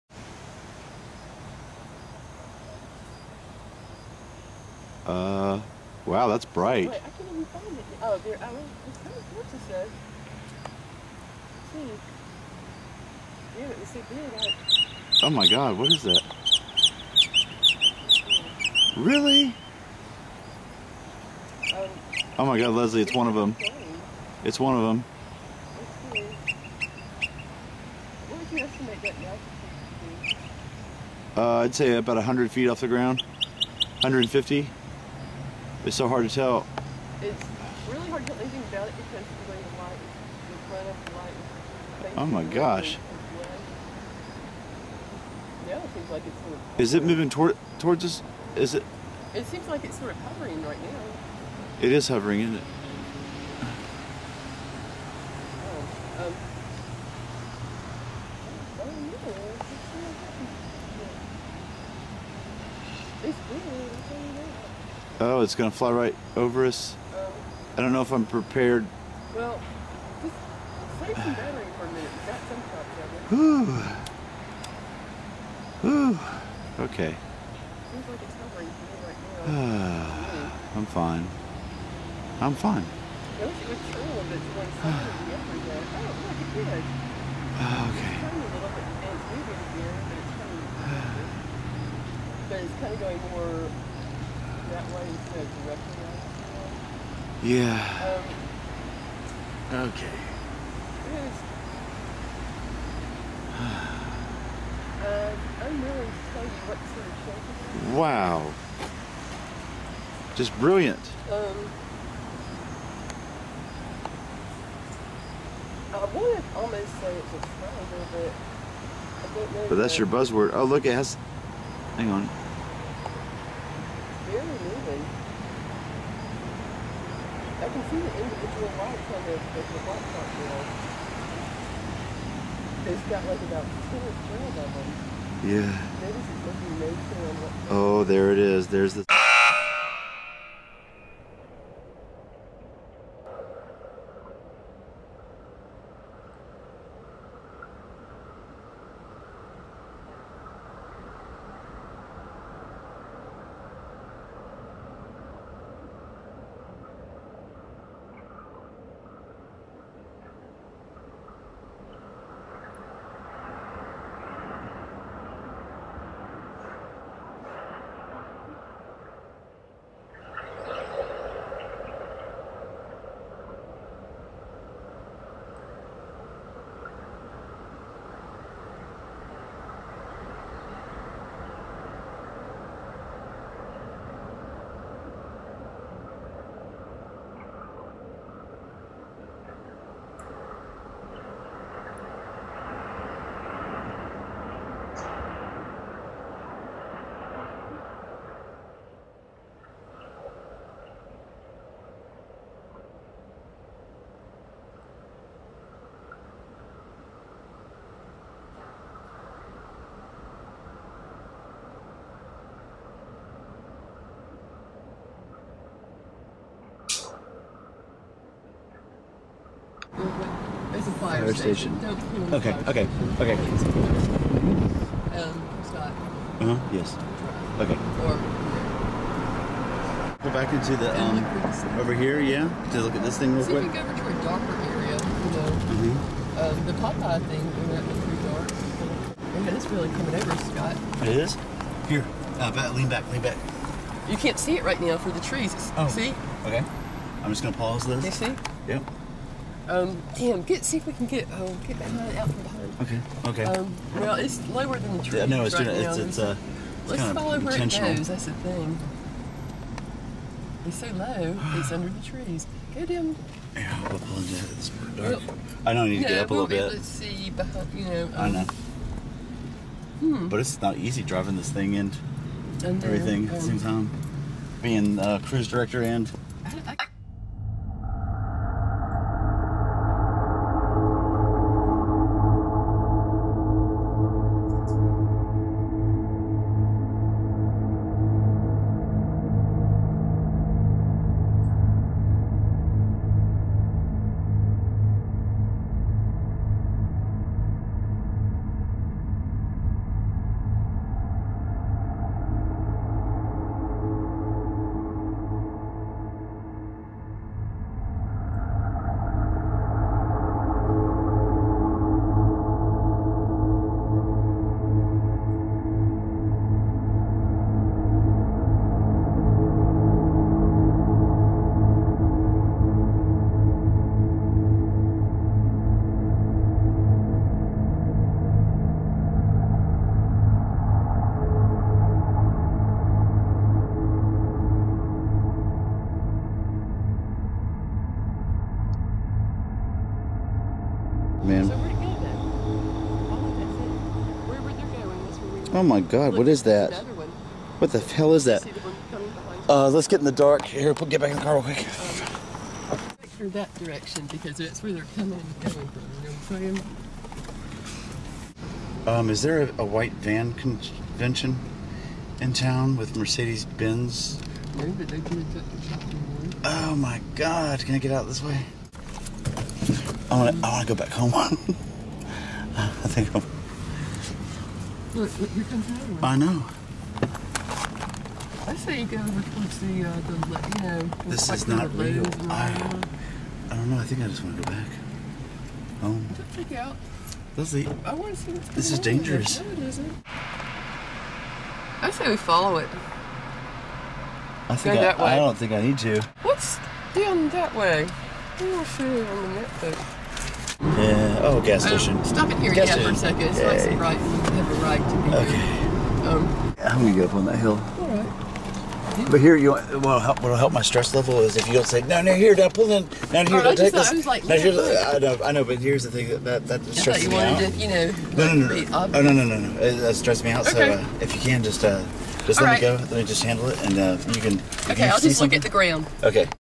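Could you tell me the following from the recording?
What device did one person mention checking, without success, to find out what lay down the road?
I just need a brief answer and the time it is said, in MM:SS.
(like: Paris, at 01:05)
netbook, at 06:39.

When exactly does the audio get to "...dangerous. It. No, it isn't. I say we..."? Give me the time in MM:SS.
06:28.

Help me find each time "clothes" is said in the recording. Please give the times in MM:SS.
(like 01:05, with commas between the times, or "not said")
not said.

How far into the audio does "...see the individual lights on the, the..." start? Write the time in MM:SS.
02:07.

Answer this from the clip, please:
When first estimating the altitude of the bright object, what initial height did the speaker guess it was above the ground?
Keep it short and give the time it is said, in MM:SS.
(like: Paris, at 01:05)
100 feet, at 00:32.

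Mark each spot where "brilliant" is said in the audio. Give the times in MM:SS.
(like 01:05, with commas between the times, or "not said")
01:50.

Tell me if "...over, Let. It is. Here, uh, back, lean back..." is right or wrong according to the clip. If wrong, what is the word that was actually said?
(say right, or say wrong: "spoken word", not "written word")
wrong: "Scott", not "Let".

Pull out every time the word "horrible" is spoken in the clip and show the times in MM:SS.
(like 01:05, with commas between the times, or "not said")
not said.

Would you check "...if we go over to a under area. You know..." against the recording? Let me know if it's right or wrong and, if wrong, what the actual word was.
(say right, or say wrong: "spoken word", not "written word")
wrong: "darker", not "under".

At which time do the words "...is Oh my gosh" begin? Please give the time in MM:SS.
00:42.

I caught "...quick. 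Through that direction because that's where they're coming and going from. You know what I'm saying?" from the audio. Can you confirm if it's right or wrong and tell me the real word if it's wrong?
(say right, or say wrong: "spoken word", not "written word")
right.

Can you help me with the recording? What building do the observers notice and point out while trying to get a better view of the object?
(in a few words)
fire station.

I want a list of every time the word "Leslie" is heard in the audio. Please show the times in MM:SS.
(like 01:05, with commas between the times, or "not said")
00:22.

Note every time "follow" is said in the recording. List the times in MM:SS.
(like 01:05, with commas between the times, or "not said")
04:17, 06:32.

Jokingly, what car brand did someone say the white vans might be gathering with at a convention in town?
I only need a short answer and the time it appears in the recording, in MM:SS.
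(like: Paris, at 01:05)
Mercedes Benz, at 06:02.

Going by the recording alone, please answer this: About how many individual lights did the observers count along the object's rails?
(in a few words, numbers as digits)
two or three.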